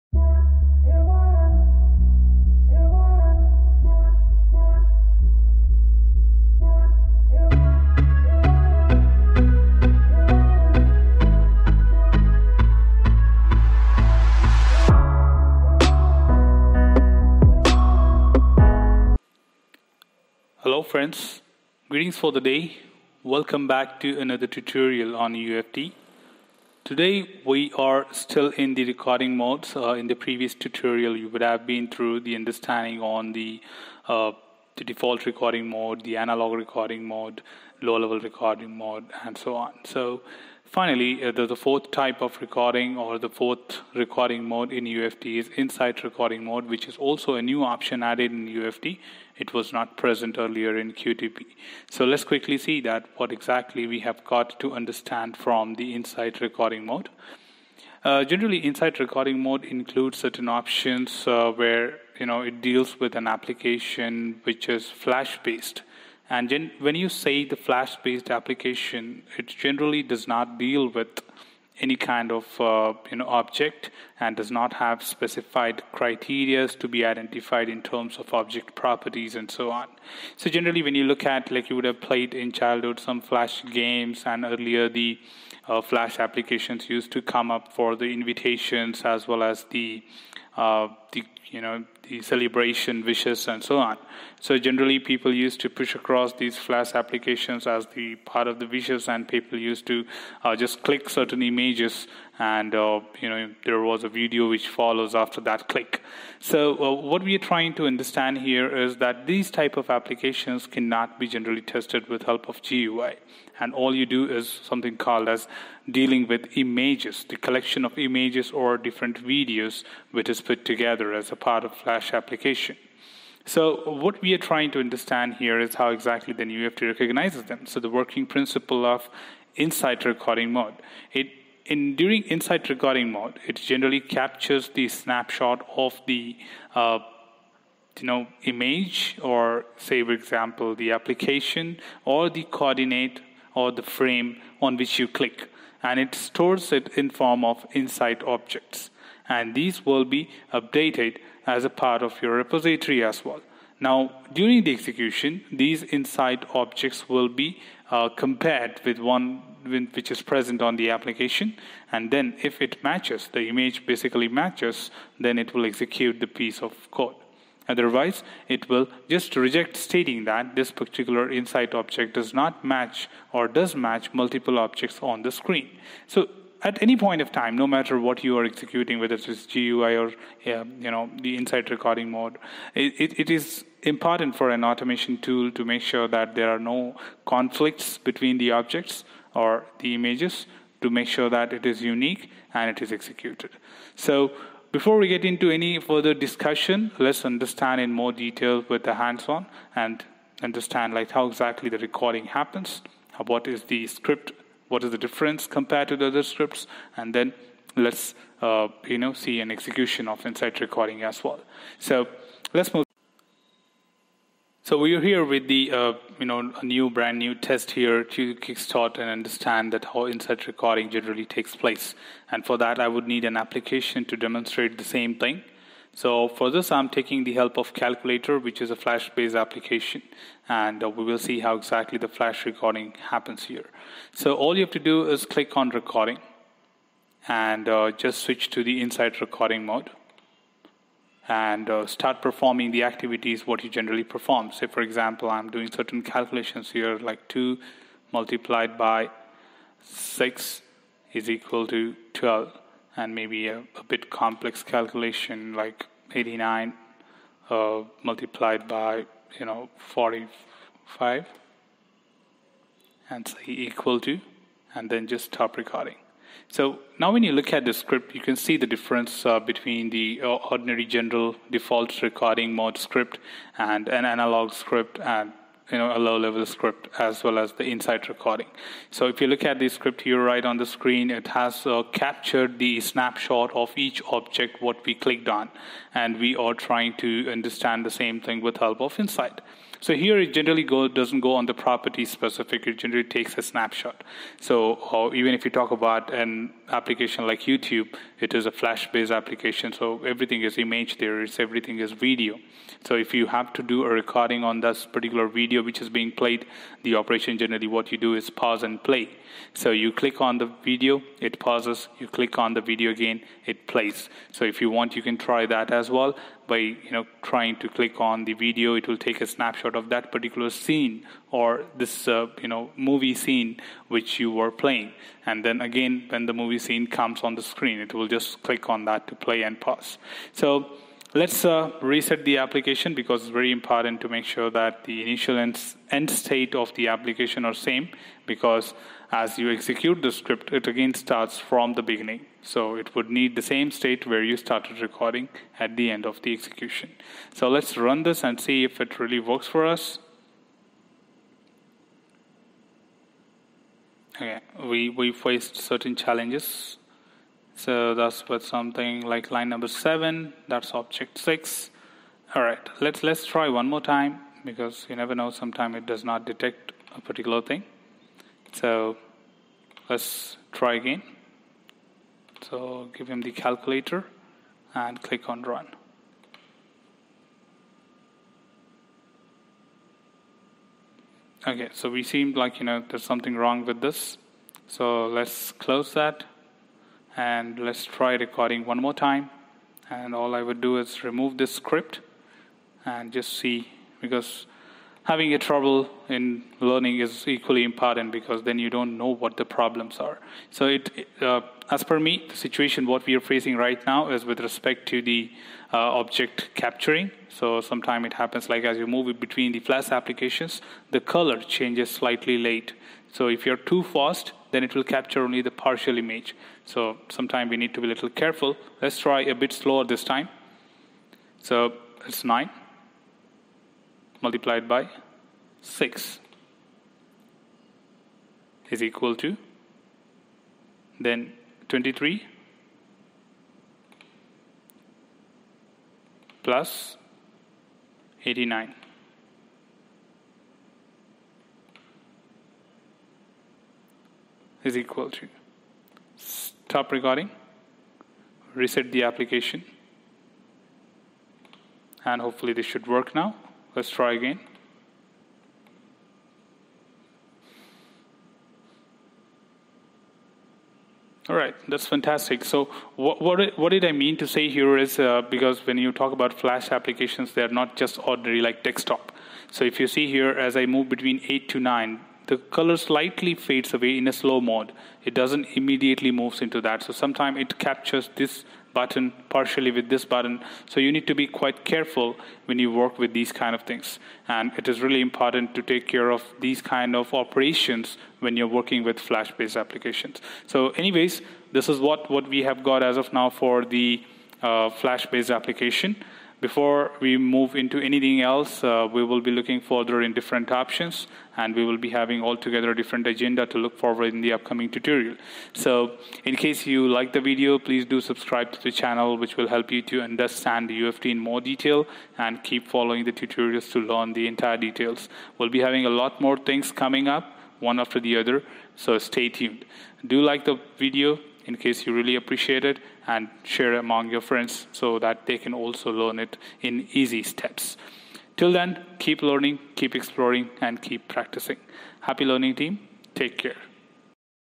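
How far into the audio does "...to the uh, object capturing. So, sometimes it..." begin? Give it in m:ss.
6:44.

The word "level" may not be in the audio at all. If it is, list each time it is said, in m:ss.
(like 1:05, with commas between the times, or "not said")
0:37, 4:36.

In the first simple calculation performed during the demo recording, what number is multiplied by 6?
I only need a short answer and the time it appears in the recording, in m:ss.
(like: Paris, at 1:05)
2, at 4:07.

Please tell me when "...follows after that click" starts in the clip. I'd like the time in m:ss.
1:44.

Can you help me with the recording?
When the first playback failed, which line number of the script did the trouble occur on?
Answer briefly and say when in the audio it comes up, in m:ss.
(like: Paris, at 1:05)
7, at 5:59.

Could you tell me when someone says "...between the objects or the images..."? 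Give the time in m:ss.
3:07.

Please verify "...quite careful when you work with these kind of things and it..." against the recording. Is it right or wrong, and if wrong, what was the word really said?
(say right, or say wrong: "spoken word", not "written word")
right.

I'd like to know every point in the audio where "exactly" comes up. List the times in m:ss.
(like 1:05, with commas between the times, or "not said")
0:53, 2:05, 3:21, 3:51.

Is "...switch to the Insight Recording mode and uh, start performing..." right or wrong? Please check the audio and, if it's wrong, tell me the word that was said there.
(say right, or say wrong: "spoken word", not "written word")
right.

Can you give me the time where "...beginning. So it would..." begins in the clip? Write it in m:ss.
5:41.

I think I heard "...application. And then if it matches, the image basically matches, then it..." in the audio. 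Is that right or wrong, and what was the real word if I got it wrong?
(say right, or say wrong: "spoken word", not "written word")
right.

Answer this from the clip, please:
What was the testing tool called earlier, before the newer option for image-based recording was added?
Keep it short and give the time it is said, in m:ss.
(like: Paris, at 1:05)
QTP, at 0:50.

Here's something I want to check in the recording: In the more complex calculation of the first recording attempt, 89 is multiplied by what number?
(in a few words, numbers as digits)
45.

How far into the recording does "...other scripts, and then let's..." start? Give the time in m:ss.
3:26.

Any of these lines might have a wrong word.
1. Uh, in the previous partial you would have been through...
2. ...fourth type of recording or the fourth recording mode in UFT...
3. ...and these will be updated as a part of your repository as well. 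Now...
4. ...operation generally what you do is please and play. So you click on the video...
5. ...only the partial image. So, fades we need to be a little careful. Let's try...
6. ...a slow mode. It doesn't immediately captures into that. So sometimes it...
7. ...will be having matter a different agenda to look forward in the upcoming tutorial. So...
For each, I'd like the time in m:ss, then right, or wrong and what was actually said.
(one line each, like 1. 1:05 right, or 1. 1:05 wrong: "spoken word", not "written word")
1. 0:29 wrong: "tutorial", not "partial"
2. 0:41 right
3. 2:29 right
4. 5:06 wrong: "pause", not "please"
5. 6:55 wrong: "sometimes", not "fades"
6. 7:54 wrong: "moves", not "captures"
7. 8:21 wrong: "altogether", not "matter".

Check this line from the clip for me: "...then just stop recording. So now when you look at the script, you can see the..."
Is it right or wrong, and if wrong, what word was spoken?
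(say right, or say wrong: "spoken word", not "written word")
right.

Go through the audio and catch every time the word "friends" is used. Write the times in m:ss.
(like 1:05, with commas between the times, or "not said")
0:20, 8:44.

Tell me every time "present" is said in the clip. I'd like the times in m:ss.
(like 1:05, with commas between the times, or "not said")
0:49, 2:40.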